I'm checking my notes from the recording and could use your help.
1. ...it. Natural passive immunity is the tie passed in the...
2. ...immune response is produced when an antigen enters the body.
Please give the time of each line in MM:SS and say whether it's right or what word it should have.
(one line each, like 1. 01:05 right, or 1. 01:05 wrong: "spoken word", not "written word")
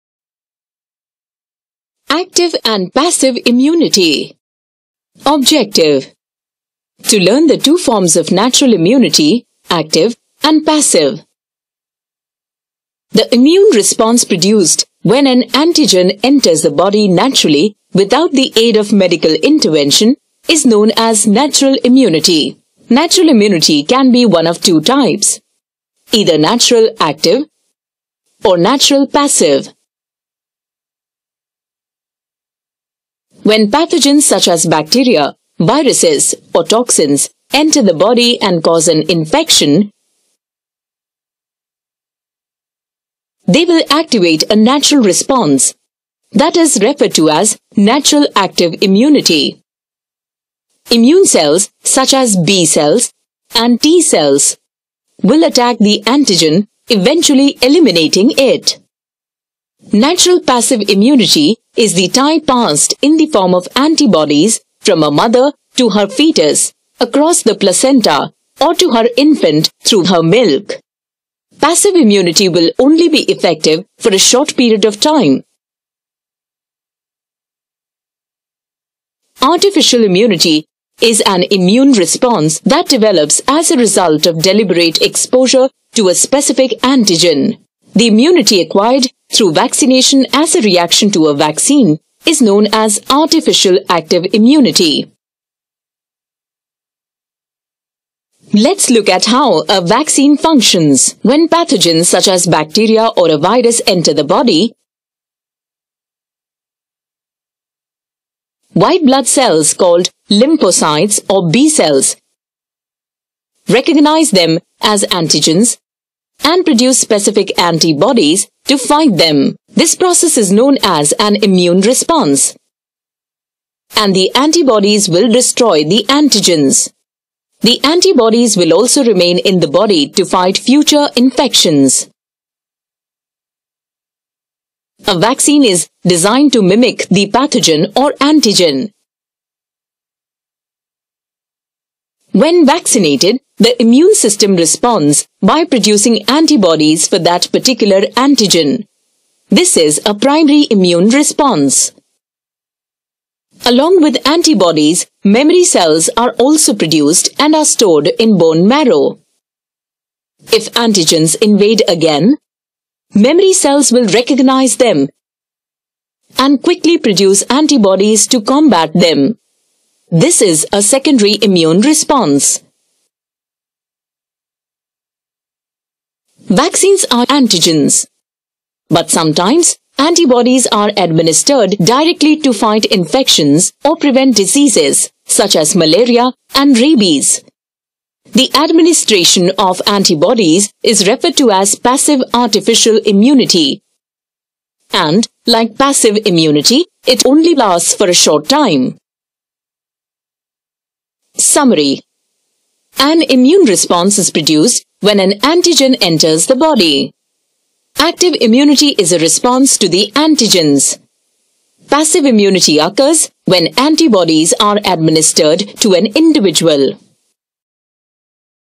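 1. 00:58 right
2. 03:23 right.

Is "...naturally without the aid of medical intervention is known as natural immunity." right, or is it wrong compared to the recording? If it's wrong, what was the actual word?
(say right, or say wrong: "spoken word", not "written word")
right.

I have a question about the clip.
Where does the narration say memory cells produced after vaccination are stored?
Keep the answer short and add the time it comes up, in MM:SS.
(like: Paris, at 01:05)
bone marrow, at 02:38.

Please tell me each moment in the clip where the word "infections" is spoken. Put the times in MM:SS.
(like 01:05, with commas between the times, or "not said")
00:39, 02:11, 03:02.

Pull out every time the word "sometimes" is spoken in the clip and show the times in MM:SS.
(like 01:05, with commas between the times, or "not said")
02:59.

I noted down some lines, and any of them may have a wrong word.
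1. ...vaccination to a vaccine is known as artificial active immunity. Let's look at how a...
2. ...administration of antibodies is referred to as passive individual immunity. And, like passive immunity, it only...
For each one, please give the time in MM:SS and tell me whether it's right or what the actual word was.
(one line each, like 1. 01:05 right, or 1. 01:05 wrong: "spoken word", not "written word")
1. 01:30 wrong: "reaction", not "vaccination"
2. 03:08 wrong: "artificial", not "individual".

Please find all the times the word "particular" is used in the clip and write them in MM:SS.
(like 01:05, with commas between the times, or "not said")
02:27.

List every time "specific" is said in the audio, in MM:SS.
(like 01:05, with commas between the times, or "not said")
01:26, 01:56.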